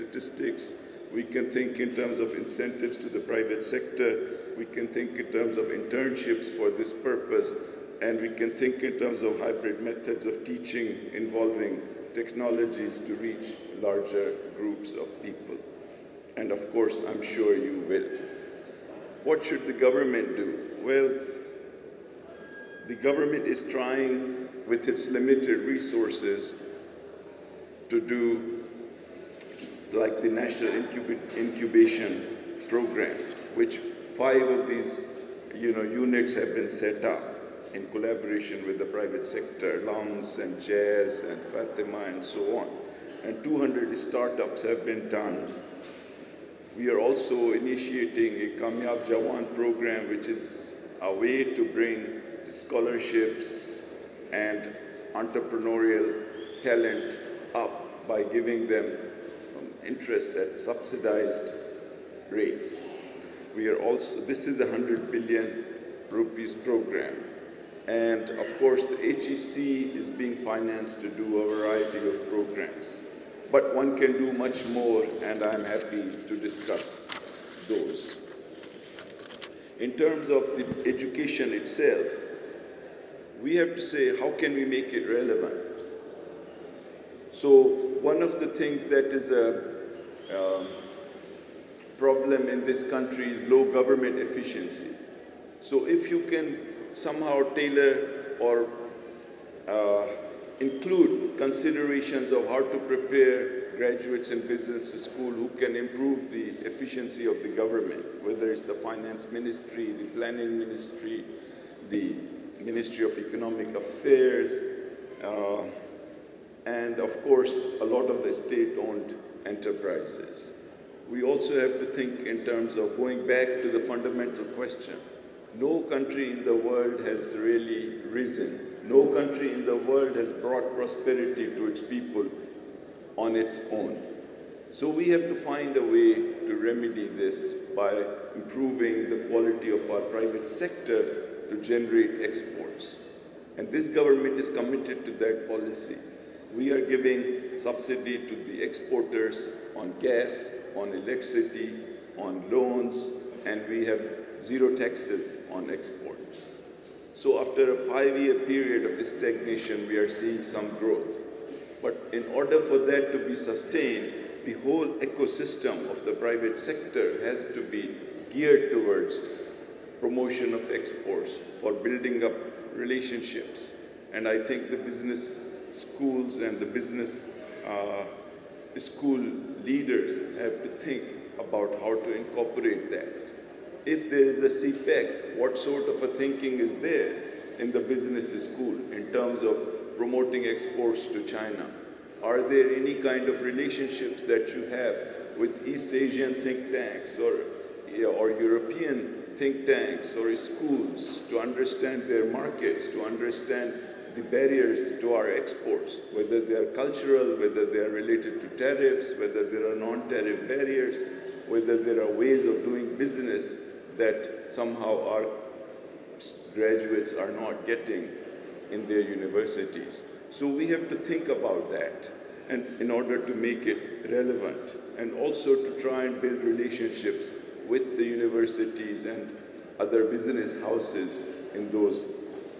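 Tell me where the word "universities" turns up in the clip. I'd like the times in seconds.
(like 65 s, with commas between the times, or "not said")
218 s, 228 s.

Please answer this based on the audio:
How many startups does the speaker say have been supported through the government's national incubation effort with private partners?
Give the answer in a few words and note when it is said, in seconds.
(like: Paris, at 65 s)
200, at 43 s.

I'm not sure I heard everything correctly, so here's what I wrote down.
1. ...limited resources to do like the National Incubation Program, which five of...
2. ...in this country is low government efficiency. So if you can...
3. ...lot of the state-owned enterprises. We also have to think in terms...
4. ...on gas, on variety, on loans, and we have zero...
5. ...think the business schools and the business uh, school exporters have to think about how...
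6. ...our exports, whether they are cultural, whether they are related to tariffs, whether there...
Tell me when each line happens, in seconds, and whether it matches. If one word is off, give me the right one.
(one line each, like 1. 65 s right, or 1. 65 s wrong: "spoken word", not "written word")
1. 25 s right
2. 92 s right
3. 117 s right
4. 149 s wrong: "electricity", not "variety"
5. 174 s wrong: "leaders", not "exporters"
6. 205 s right.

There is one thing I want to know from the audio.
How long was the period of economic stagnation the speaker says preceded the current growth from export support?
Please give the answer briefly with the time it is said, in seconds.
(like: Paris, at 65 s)
5 years, at 157 s.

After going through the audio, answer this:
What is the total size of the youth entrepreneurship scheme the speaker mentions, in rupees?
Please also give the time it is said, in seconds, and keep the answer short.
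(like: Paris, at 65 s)
100 billion rupees, at 64 s.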